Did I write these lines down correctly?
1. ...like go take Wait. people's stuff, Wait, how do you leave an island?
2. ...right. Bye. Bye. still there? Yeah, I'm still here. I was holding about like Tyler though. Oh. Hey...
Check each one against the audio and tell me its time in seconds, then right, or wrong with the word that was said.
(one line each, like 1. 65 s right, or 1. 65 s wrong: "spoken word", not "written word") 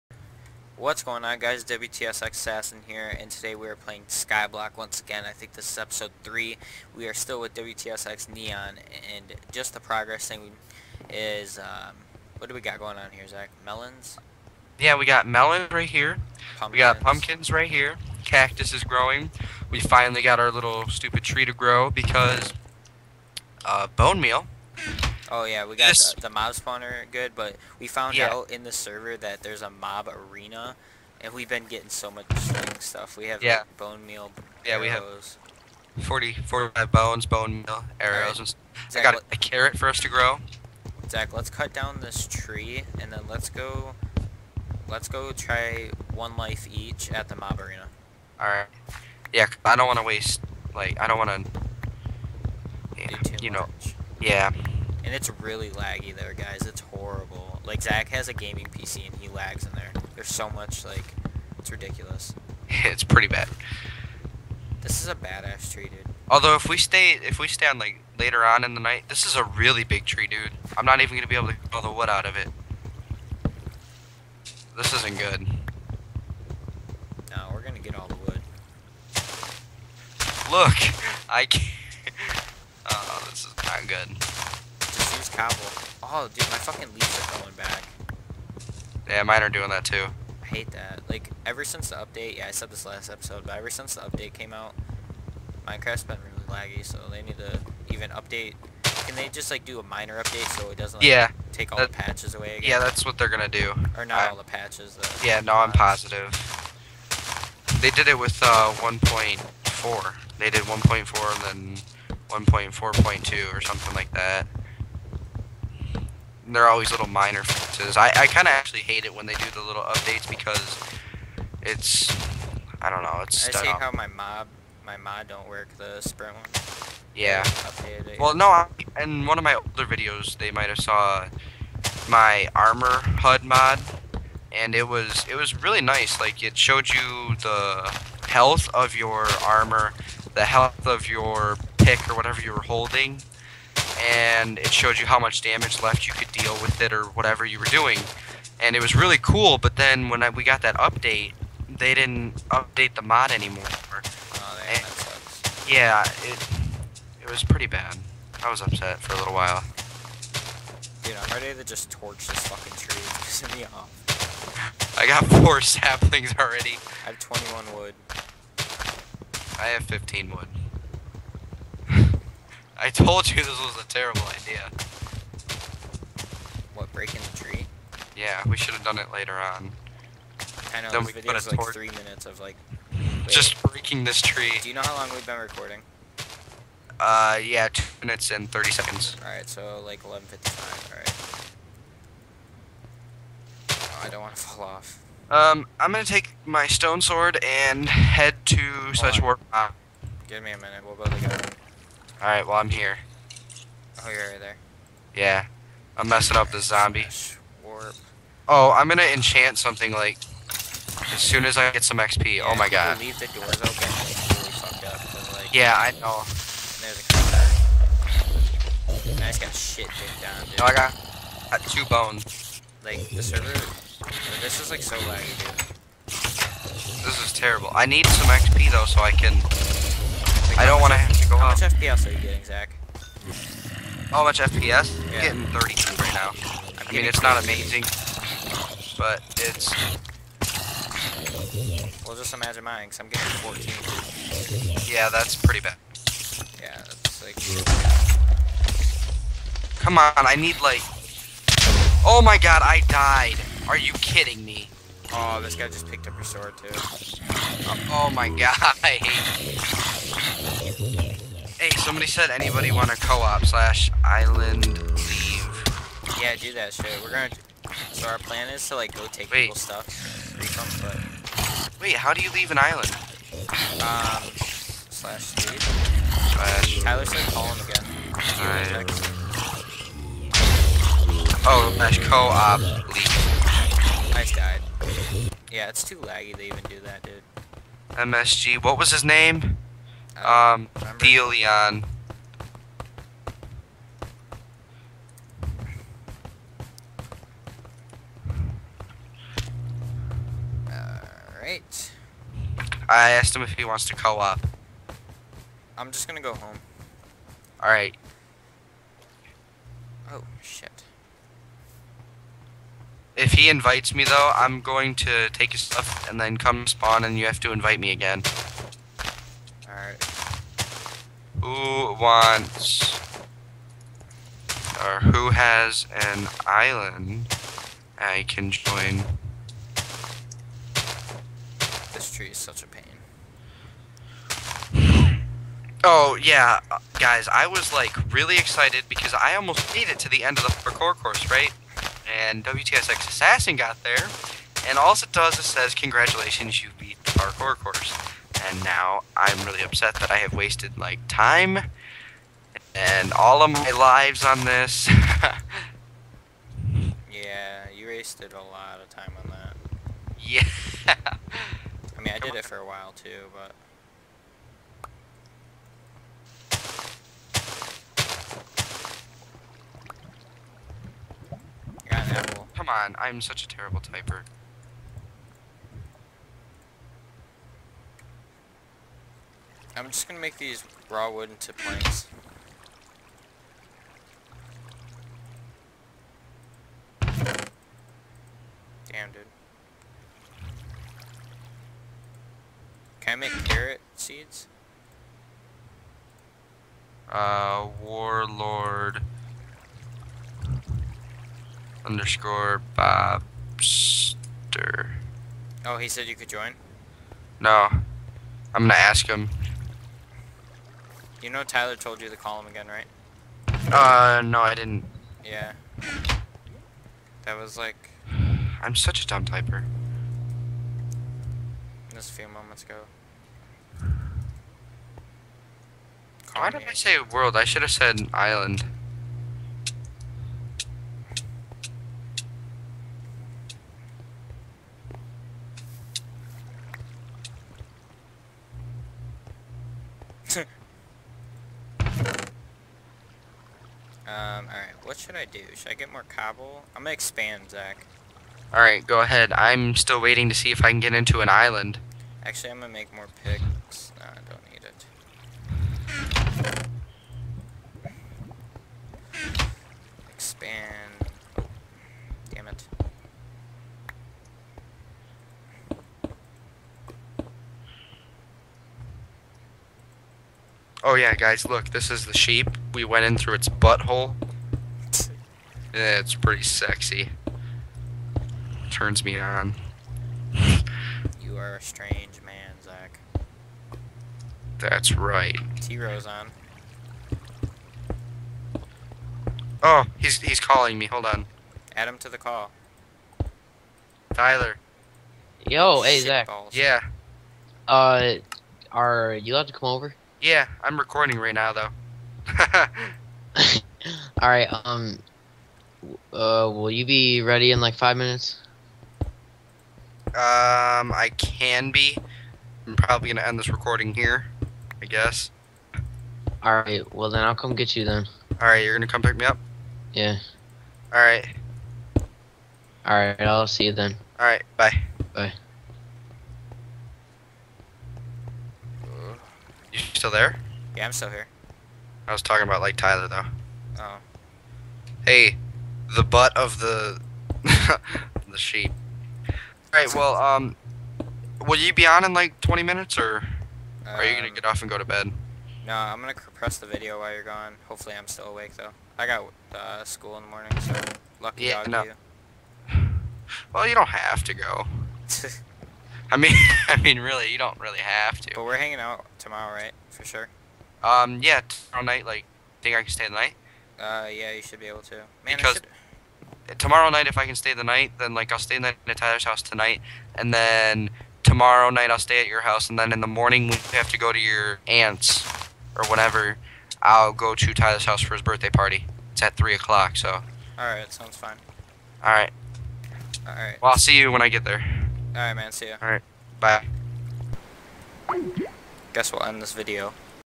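1. 268 s right
2. 524 s wrong: "talking", not "holding".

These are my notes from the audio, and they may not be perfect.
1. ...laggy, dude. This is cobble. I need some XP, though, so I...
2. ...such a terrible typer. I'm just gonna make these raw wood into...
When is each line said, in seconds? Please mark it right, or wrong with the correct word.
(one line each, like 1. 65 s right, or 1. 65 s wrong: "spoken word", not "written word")
1. 224 s wrong: "terrible", not "cobble"
2. 373 s right.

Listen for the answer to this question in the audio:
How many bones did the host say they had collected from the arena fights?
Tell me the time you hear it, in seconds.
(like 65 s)
36 s.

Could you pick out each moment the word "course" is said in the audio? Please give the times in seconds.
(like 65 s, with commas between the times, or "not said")
340 s, 347 s.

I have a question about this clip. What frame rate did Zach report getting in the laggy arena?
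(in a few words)
32.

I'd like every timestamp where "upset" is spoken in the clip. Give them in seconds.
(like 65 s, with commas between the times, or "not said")
158 s, 349 s.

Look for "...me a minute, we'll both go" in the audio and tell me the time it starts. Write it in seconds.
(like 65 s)
200 s.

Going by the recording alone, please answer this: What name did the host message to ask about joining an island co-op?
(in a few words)
Deleon.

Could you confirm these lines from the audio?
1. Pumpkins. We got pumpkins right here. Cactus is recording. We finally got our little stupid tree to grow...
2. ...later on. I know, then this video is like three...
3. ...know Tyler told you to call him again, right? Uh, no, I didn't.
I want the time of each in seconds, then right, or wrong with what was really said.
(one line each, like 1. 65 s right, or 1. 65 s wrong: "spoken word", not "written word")
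1. 16 s wrong: "growing", not "recording"
2. 179 s right
3. 411 s right.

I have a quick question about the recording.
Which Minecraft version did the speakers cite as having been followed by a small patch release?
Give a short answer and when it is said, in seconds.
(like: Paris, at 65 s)
1.4.2, at 112 s.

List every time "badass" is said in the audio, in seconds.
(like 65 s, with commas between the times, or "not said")
65 s.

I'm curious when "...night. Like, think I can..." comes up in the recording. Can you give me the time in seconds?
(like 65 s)
561 s.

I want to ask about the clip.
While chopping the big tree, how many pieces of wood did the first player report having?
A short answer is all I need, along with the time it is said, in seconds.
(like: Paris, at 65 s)
21, at 167 s.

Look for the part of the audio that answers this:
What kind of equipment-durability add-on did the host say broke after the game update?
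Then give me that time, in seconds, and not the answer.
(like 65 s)
132 s.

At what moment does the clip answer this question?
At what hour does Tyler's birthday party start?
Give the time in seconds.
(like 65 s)
579 s.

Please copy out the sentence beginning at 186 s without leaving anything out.
Uh, yeah, 2 minutes and 30 seconds.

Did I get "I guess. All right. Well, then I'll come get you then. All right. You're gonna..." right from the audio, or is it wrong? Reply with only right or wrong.
right.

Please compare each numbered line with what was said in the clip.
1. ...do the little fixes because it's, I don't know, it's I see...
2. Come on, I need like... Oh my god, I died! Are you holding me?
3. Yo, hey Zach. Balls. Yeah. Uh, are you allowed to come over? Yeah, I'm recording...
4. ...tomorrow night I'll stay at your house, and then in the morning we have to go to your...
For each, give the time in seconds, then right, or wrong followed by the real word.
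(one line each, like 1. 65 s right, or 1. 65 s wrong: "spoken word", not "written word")
1. 119 s wrong: "updates", not "fixes"
2. 249 s wrong: "kidding", not "holding"
3. 495 s right
4. 571 s right.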